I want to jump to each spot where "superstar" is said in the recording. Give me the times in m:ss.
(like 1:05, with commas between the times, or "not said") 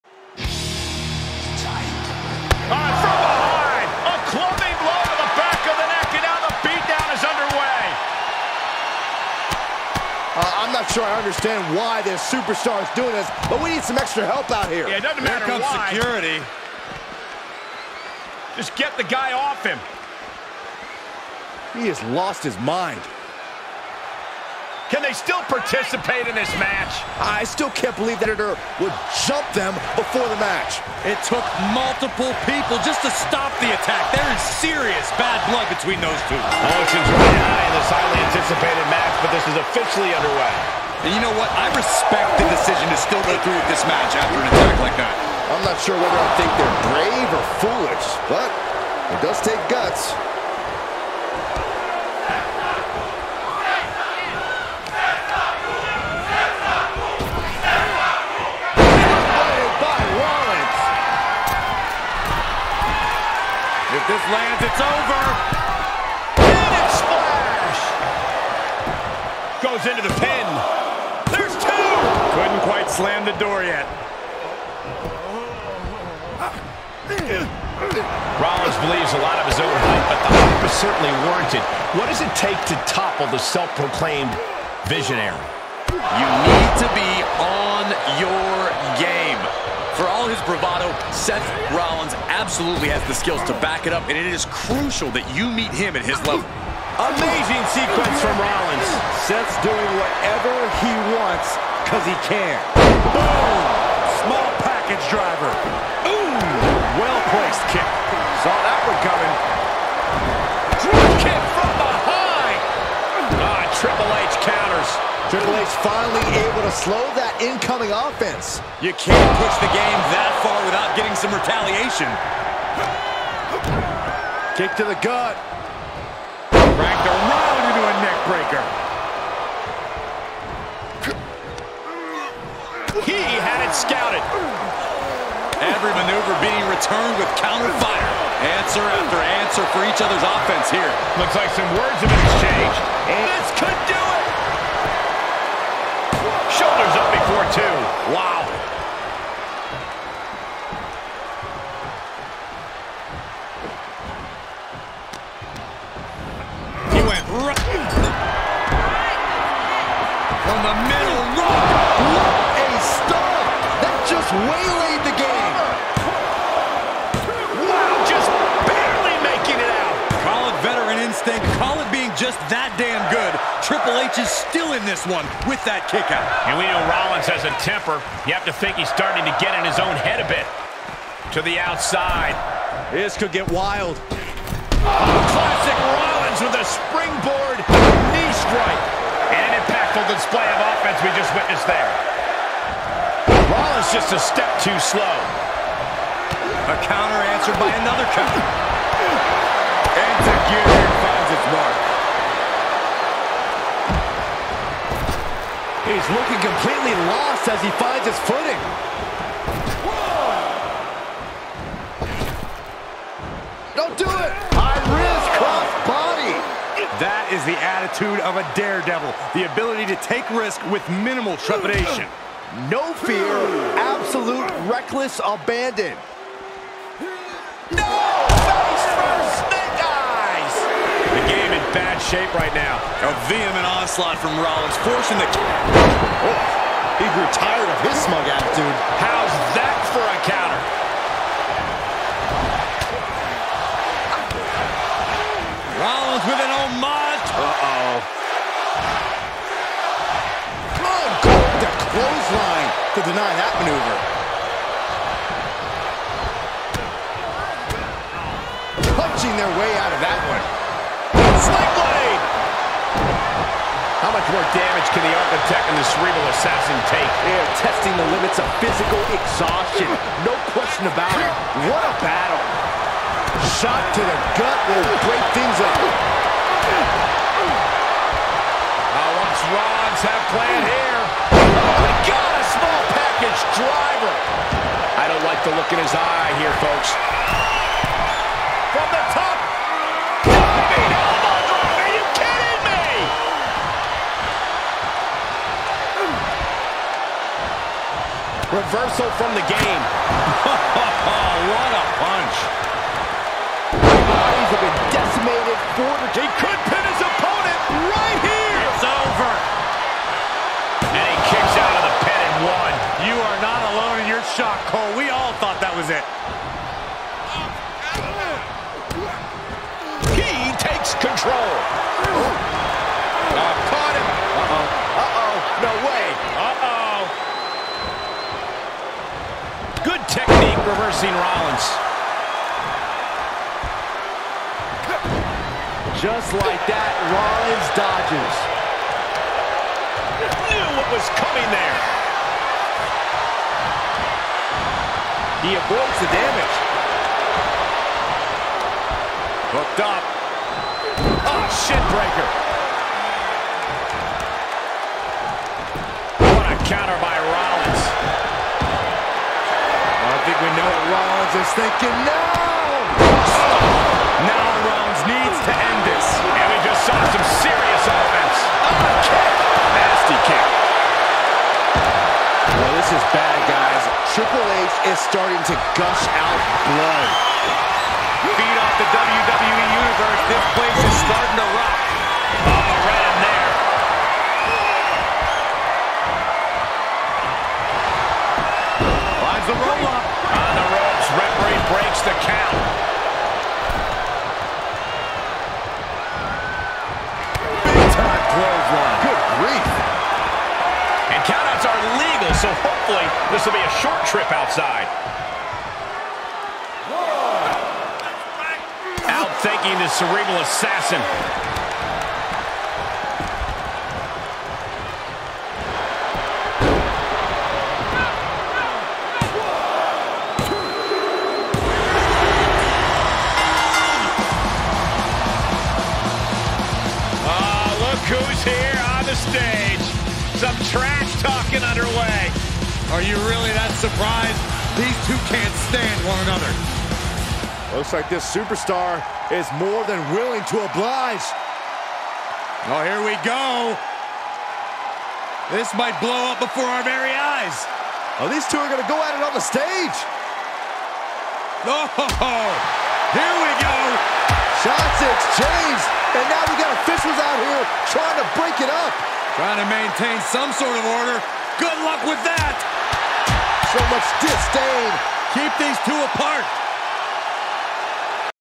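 0:12, 7:18.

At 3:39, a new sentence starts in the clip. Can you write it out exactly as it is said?
The ability to take risk with minimal trepidation.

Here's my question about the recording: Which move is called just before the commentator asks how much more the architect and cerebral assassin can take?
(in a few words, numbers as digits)
Sling blade.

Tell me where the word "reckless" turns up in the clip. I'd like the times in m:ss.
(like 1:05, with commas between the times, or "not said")
3:44.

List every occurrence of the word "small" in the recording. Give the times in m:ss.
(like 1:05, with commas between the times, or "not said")
1:44, 4:42.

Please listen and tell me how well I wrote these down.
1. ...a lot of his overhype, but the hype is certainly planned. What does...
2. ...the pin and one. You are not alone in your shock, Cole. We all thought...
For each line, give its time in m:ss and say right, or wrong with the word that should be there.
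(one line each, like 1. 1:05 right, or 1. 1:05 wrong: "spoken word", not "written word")
1. 1:19 wrong: "warranted", not "planned"
2. 5:11 right.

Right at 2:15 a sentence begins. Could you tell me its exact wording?
Every maneuver being returned with counter fire.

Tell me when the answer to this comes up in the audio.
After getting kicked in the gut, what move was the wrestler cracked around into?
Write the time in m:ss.
2:08.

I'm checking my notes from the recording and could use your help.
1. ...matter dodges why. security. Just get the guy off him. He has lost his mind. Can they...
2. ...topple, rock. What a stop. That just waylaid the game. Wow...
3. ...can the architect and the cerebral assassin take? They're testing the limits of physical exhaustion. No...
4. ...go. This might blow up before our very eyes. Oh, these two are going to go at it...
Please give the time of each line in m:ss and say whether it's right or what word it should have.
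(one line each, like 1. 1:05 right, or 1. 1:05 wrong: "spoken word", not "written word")
1. 0:15 wrong: "comes", not "dodges"
2. 2:40 wrong: "middle", not "topple"
3. 4:24 right
4. 7:23 right.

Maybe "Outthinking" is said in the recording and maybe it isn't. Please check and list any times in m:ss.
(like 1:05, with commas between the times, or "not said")
6:49.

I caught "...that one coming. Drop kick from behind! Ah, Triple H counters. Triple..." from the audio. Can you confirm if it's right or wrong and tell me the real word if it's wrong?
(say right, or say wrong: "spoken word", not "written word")
right.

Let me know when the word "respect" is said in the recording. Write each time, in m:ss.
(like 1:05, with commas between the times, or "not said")
0:41.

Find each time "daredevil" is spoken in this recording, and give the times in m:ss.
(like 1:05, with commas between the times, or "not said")
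3:38.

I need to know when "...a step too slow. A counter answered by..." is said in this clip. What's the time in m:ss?
3:14.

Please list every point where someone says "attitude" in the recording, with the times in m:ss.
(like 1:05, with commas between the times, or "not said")
3:37, 3:58.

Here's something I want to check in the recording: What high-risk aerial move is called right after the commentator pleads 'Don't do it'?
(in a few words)
Cross body.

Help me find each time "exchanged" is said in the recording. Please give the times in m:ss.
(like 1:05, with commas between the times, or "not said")
2:22, 7:35.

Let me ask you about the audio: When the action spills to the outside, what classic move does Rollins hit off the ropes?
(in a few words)
Springboard knee strike.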